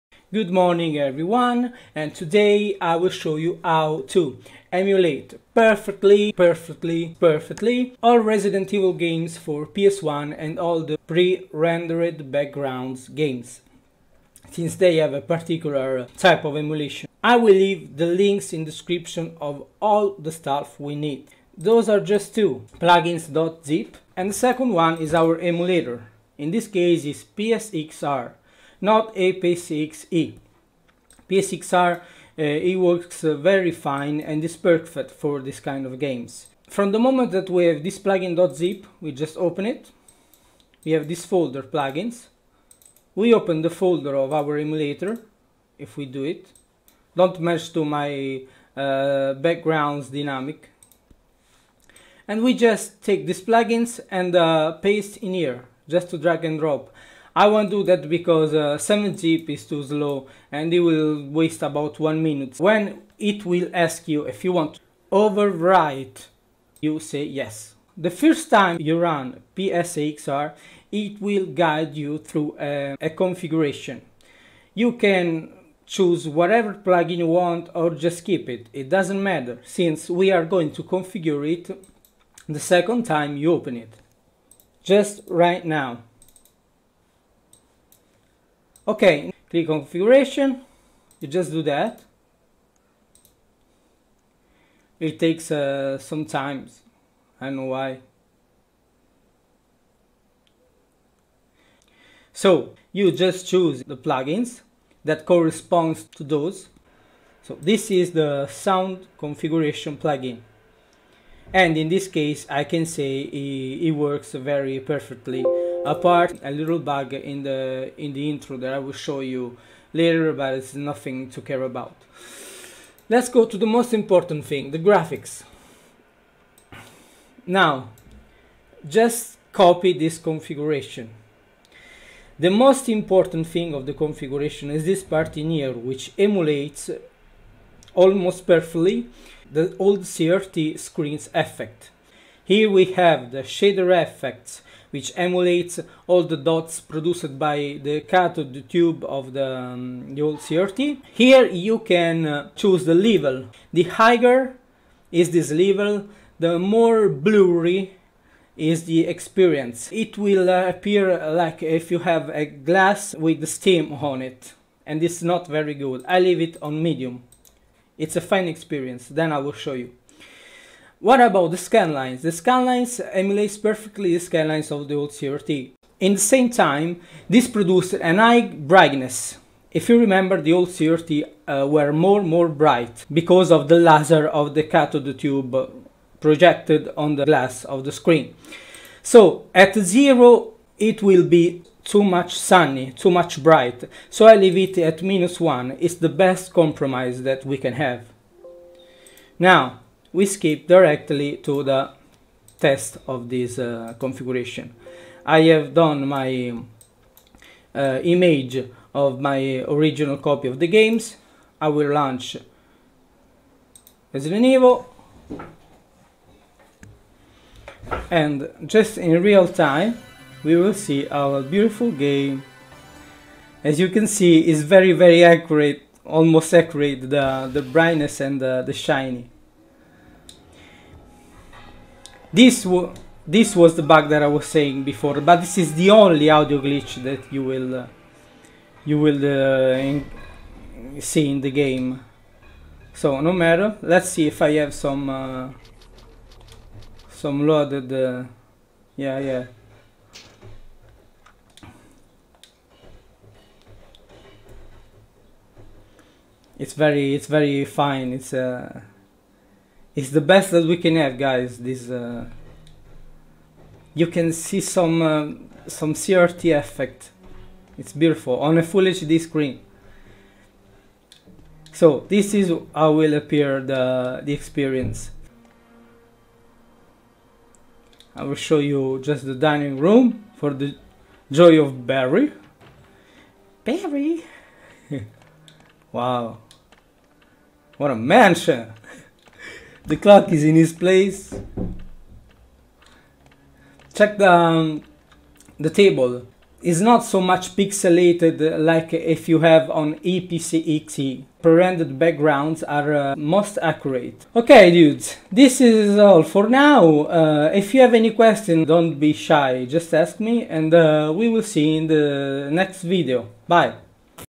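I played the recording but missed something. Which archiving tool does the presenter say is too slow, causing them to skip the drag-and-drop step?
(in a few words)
7 zip.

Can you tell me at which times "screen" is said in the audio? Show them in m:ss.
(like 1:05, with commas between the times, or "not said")
2:20, 3:07, 4:29.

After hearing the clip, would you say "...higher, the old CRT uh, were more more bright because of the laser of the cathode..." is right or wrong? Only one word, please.
wrong.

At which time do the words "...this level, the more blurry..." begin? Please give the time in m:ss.
2:35.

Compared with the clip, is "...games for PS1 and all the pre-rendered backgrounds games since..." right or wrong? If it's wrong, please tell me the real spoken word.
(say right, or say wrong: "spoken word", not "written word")
right.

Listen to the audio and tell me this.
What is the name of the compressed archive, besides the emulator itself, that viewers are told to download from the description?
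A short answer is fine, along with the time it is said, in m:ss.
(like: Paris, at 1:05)
plugins.zip, at 0:22.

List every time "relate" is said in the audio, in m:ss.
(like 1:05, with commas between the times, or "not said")
not said.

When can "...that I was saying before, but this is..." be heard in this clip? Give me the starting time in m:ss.
3:54.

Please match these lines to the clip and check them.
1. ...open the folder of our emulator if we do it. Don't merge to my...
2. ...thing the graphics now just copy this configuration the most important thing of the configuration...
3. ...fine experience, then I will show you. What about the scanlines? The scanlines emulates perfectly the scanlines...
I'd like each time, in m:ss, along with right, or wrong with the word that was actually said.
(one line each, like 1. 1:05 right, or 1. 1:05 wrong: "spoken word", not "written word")
1. 0:43 right
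2. 2:04 right
3. 2:48 right.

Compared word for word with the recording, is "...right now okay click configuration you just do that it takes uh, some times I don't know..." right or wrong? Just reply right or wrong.
right.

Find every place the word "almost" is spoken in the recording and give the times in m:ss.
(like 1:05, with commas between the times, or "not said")
2:17, 3:46.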